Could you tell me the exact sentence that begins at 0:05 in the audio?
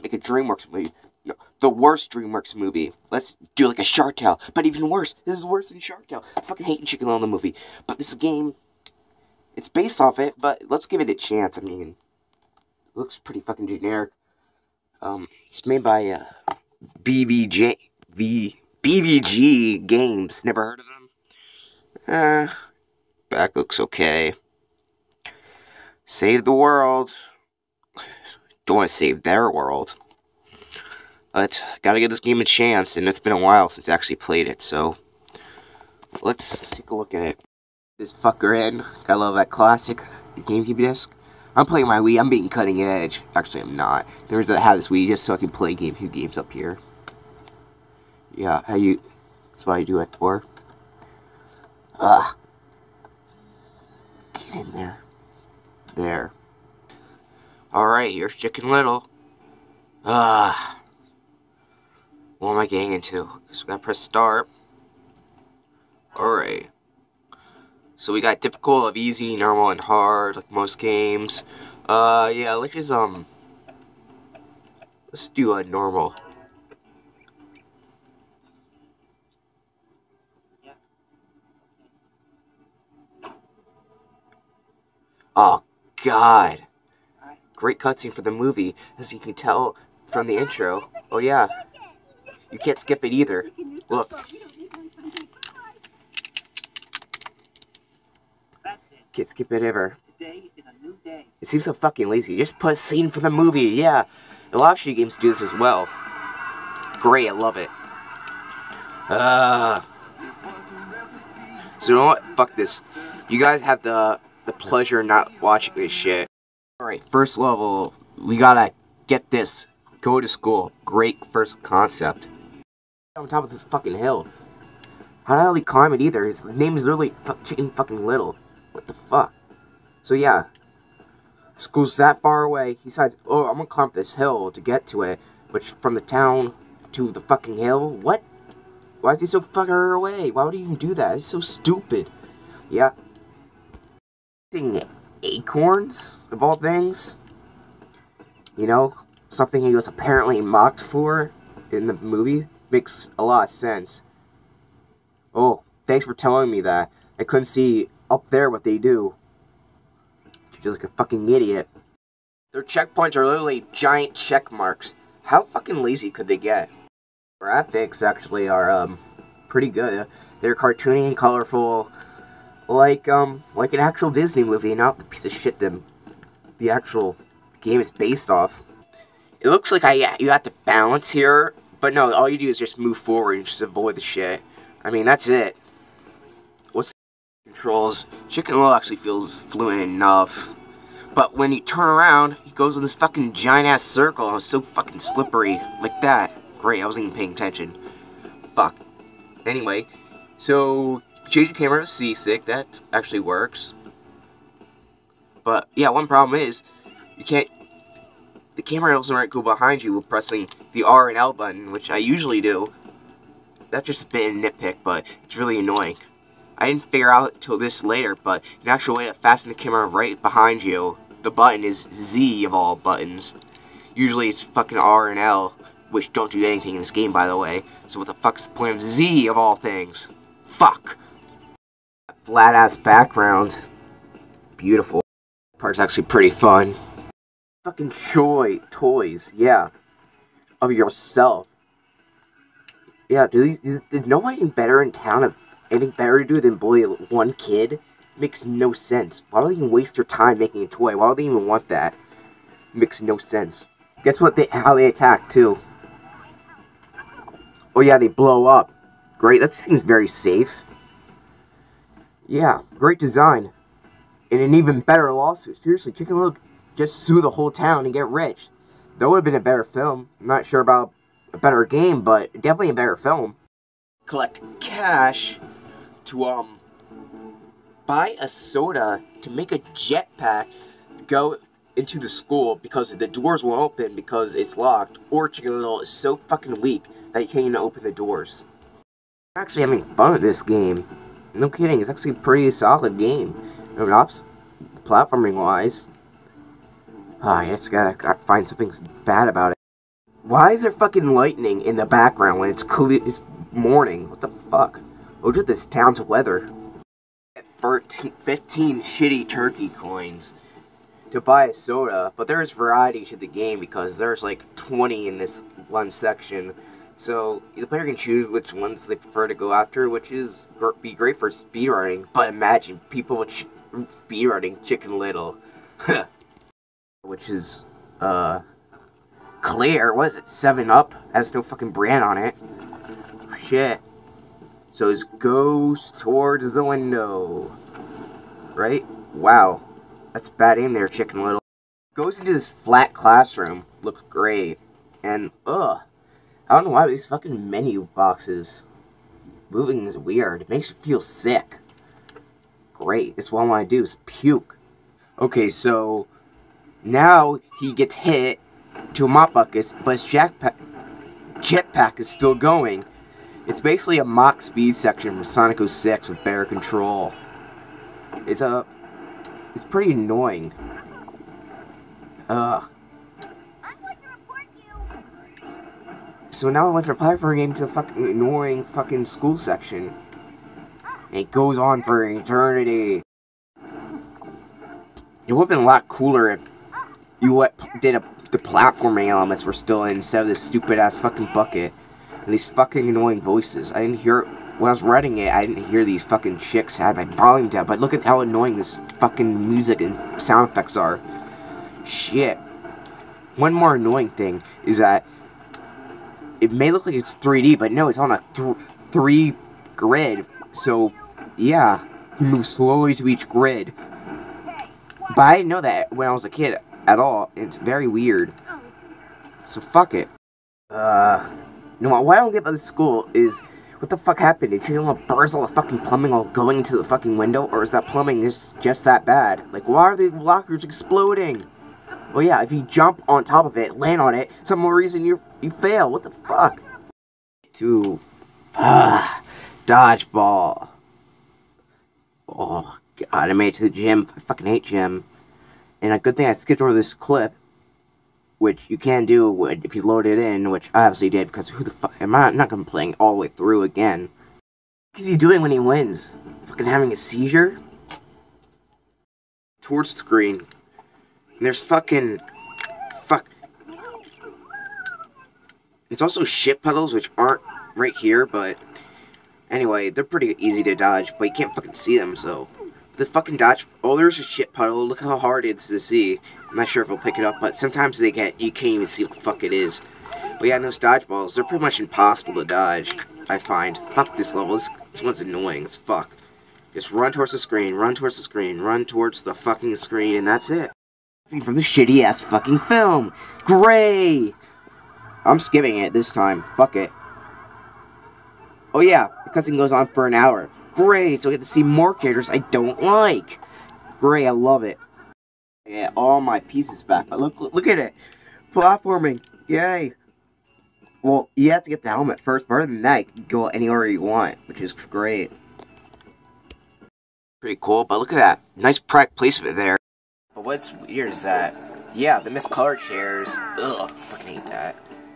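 This is worse than Shark Tale.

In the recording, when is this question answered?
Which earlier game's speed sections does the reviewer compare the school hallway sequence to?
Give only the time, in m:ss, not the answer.
6:05.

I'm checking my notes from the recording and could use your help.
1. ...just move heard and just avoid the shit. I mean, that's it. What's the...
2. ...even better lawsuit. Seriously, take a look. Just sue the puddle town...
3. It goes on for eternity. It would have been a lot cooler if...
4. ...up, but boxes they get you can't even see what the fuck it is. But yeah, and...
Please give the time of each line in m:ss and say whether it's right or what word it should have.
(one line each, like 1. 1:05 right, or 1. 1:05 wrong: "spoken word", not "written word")
1. 3:02 wrong: "forward", not "heard"
2. 4:24 wrong: "whole", not "puddle"
3. 6:21 right
4. 7:57 wrong: "sometimes", not "boxes".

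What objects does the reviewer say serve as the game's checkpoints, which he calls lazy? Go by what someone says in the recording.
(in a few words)
Giant check marks.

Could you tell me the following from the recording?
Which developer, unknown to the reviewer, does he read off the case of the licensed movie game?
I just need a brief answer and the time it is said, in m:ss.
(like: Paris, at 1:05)
BVG Games, at 0:18.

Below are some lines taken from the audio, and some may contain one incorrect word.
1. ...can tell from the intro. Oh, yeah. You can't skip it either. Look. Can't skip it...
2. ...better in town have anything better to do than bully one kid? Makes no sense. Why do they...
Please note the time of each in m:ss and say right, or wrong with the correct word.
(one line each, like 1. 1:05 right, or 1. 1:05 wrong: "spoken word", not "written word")
1. 1:29 right
2. 4:04 right.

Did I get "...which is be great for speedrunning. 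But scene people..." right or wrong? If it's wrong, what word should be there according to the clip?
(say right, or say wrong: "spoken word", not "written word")
wrong: "imagine", not "scene".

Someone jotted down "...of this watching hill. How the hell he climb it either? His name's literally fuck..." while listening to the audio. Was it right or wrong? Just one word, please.
wrong.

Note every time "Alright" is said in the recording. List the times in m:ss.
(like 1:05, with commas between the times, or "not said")
1:06, 1:56.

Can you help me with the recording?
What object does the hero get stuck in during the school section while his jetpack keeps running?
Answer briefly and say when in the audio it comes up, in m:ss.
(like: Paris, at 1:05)
Mop bucket, at 5:59.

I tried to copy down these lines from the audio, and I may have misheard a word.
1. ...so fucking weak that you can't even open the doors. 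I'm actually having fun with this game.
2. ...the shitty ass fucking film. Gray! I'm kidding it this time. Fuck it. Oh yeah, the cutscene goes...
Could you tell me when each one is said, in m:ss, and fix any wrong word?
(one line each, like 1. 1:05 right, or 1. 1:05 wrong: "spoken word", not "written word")
1. 4:45 right
2. 8:11 wrong: "skipping", not "kidding".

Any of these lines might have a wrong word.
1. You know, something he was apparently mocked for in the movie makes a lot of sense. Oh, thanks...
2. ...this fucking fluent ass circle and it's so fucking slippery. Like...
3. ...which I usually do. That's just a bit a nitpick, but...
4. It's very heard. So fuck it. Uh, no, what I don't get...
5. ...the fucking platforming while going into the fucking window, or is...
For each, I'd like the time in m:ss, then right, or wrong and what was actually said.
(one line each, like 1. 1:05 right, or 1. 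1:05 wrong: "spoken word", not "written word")
1. 2:28 right
2. 3:12 wrong: "giant", not "fluent"
3. 3:31 right
4. 6:57 wrong: "weird", not "heard"
5. 7:05 wrong: "plumbing", not "platforming".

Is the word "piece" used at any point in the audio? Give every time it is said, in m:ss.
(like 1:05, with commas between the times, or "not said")
2:55, 8:26.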